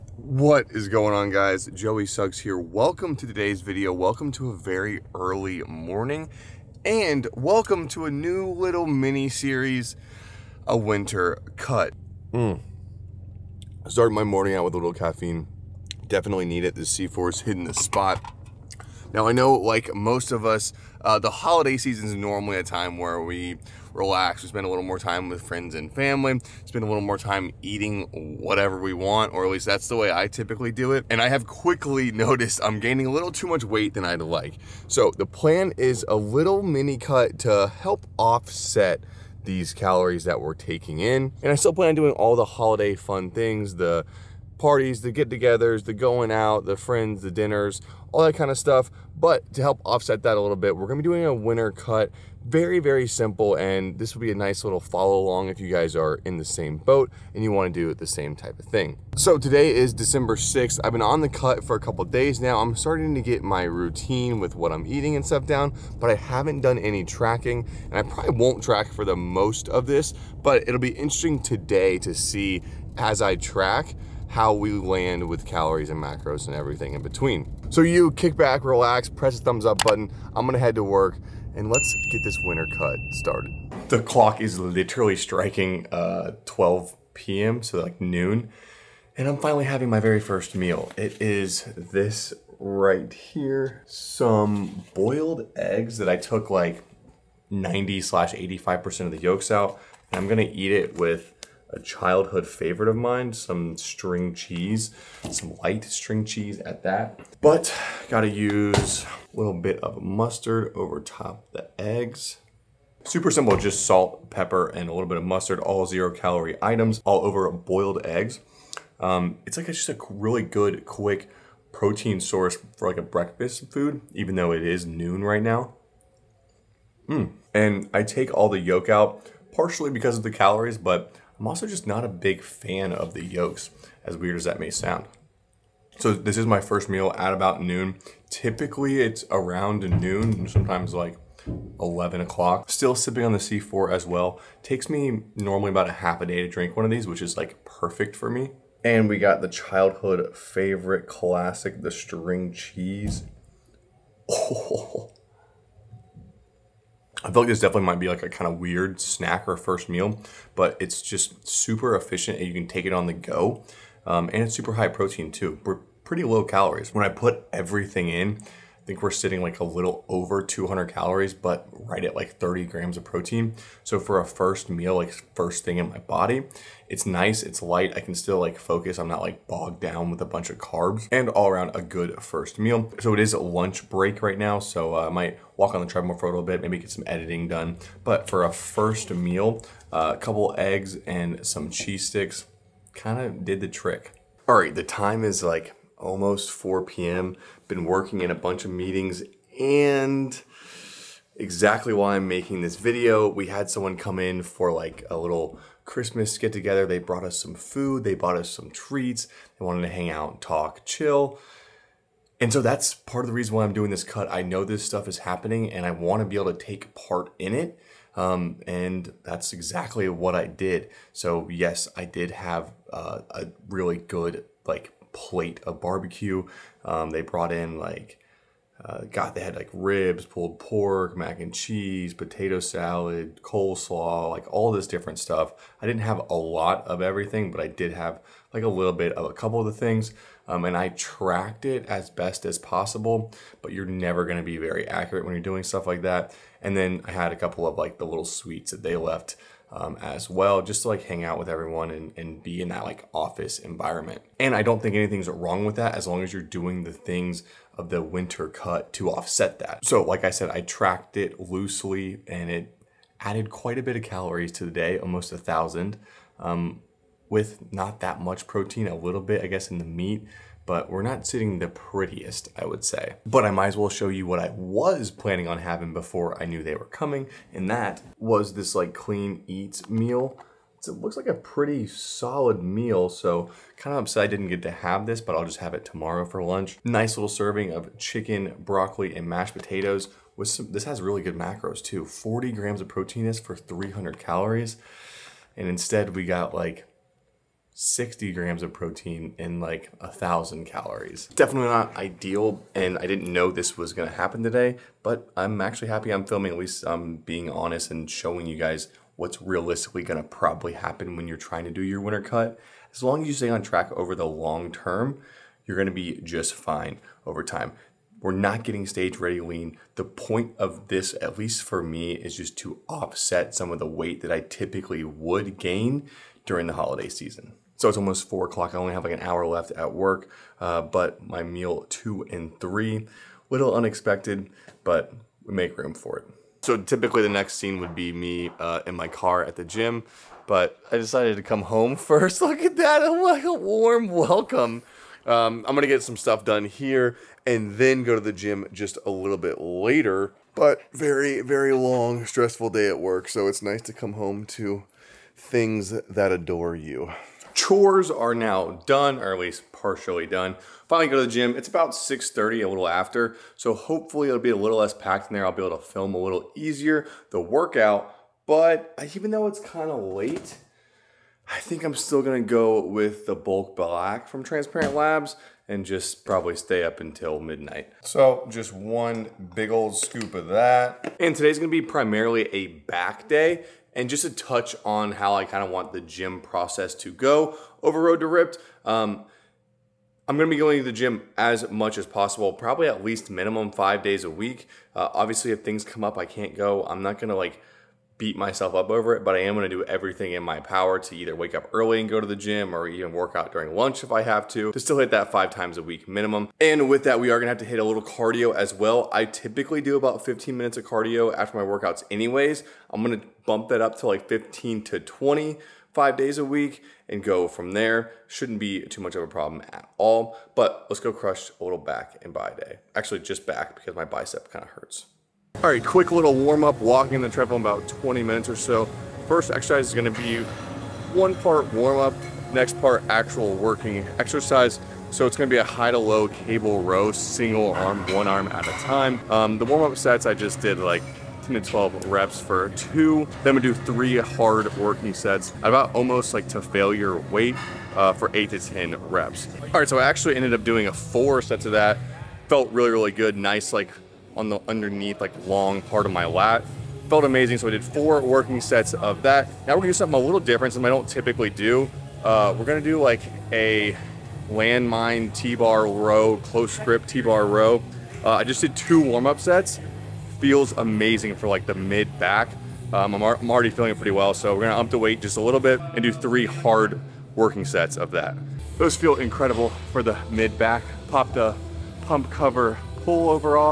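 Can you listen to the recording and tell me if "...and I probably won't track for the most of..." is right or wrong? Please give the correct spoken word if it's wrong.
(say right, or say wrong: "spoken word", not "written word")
right.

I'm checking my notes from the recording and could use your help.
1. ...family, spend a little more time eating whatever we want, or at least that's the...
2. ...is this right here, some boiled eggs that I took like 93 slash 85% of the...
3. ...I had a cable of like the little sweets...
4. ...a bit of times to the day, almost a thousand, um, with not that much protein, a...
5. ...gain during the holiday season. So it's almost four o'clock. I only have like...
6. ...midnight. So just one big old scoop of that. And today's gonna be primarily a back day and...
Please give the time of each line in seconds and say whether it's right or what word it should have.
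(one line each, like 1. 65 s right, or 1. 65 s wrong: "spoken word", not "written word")
1. 25 s right
2. 91 s wrong: "90", not "93"
3. 247 s wrong: "couple", not "cable"
4. 263 s wrong: "calories", not "times"
5. 325 s right
6. 377 s right.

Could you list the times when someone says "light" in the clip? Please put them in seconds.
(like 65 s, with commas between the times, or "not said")
105 s, 177 s.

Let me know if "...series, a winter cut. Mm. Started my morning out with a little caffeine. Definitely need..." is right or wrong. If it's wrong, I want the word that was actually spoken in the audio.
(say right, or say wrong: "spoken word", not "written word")
right.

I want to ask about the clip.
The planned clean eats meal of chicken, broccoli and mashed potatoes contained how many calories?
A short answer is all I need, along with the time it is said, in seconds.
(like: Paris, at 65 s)
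300 calories, at 293 s.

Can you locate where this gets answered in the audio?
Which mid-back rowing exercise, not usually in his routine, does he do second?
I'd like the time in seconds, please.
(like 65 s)
466 s.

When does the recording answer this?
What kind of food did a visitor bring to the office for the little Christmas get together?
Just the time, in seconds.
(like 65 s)
225 s.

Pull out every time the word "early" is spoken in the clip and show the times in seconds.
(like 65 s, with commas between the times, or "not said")
5 s, 401 s.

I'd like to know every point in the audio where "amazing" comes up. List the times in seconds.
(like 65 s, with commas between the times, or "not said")
457 s, 470 s.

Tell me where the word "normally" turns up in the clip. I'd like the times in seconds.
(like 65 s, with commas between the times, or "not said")
22 s, 145 s.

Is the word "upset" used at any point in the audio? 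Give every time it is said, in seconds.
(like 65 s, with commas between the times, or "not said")
284 s.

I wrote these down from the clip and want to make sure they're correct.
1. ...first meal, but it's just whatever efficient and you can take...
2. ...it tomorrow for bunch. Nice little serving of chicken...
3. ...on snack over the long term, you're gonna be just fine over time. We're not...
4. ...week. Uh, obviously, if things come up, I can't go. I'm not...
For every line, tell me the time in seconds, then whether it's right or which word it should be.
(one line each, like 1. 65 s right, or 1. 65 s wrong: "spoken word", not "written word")
1. 159 s wrong: "super", not "whatever"
2. 285 s wrong: "lunch", not "bunch"
3. 313 s wrong: "track", not "snack"
4. 394 s right.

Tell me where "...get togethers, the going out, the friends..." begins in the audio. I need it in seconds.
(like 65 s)
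45 s.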